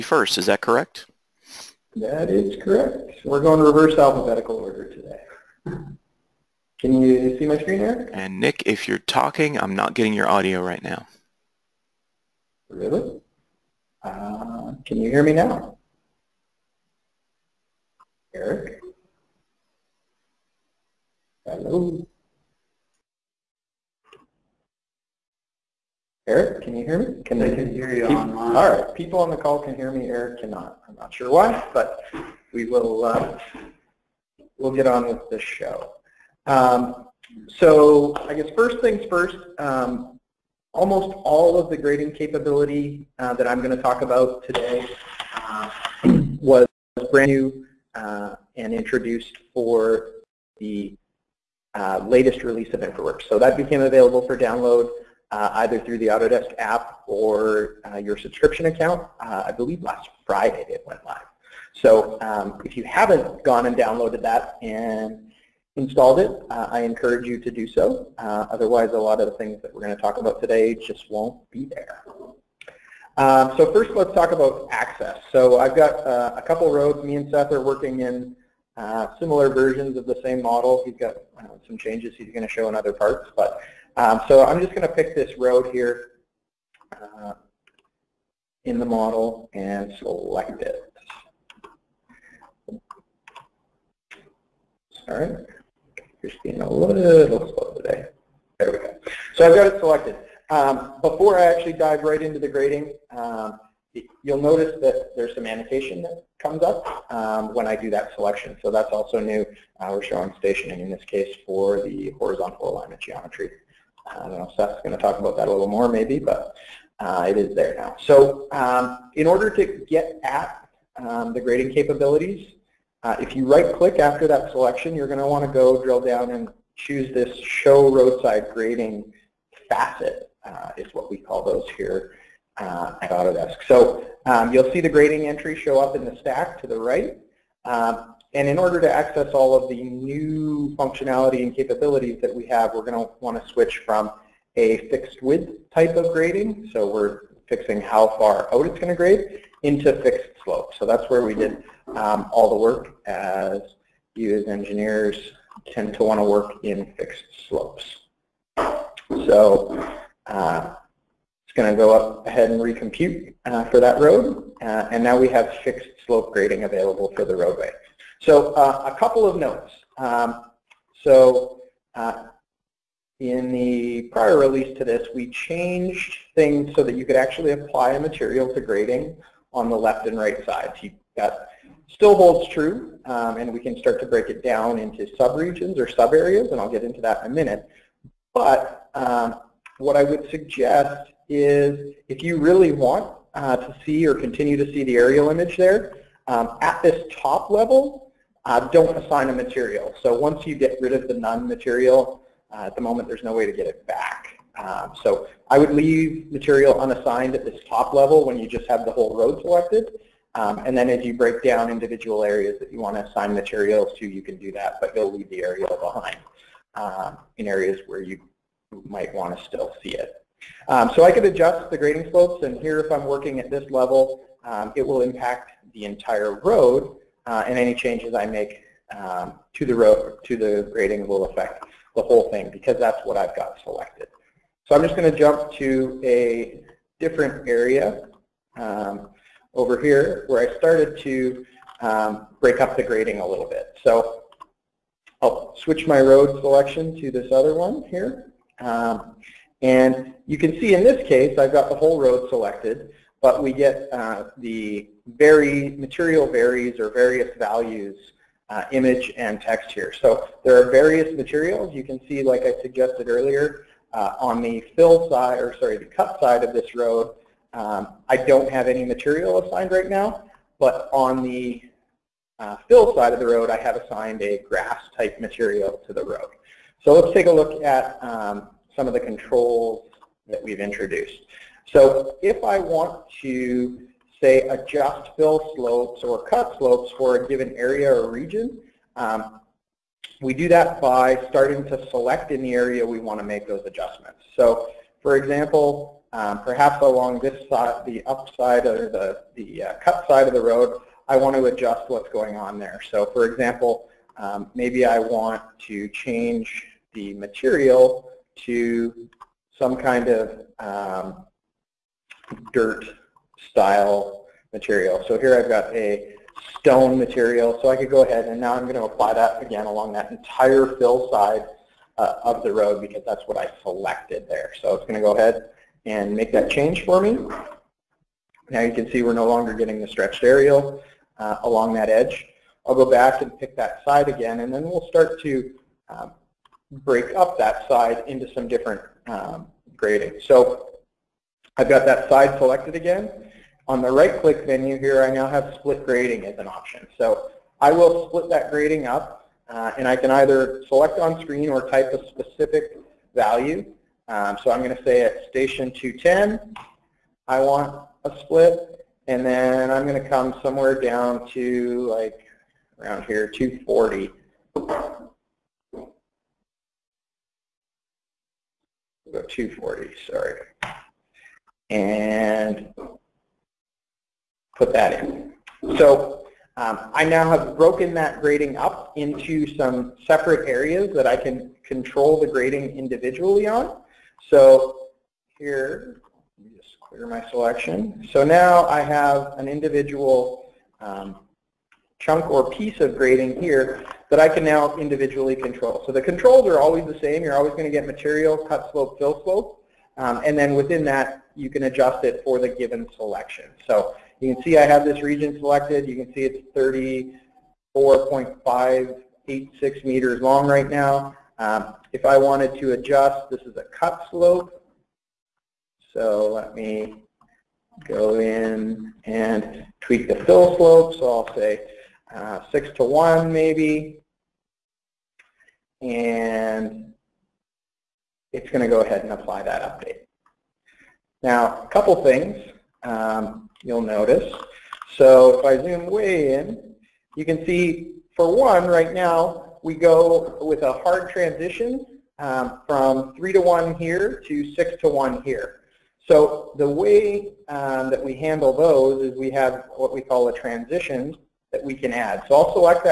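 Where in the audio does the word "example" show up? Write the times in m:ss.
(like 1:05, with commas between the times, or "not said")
4:55, 5:03.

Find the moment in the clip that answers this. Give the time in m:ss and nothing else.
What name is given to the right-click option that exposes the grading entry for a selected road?
2:07.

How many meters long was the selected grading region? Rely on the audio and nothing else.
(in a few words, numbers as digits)
34.586 meters.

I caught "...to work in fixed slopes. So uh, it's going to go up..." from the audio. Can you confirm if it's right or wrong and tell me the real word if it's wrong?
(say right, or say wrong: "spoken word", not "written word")
right.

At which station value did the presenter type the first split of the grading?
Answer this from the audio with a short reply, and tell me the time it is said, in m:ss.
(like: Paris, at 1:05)
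210, at 5:55.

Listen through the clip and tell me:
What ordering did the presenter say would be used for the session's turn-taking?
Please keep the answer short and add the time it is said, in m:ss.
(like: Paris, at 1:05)
Reverse alphabetical order, at 0:03.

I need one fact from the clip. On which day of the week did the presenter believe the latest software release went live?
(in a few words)
Friday.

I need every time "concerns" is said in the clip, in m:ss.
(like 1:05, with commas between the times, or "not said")
not said.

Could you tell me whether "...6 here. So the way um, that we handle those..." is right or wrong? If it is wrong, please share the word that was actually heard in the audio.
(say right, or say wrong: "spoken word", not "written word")
wrong: "1", not "6".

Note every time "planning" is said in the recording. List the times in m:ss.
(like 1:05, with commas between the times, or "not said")
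not said.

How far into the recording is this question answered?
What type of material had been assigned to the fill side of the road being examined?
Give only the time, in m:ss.
4:34.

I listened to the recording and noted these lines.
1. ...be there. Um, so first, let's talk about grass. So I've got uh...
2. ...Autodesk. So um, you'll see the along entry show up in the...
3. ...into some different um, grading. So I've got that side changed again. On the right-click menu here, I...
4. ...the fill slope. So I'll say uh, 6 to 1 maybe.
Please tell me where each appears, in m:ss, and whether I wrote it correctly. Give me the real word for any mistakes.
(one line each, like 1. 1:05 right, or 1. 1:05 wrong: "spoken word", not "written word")
1. 1:11 wrong: "access", not "grass"
2. 2:13 wrong: "grading", not "along"
3. 5:38 wrong: "selected", not "changed"
4. 7:00 right.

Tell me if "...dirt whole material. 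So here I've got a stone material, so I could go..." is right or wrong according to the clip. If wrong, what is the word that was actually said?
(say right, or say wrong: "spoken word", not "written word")
wrong: "style", not "whole".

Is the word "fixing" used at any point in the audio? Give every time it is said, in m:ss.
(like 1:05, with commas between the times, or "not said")
2:27.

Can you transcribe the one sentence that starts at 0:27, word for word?
Can they can hear you people, online.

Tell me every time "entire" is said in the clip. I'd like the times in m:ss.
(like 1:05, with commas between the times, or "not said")
3:45, 5:20.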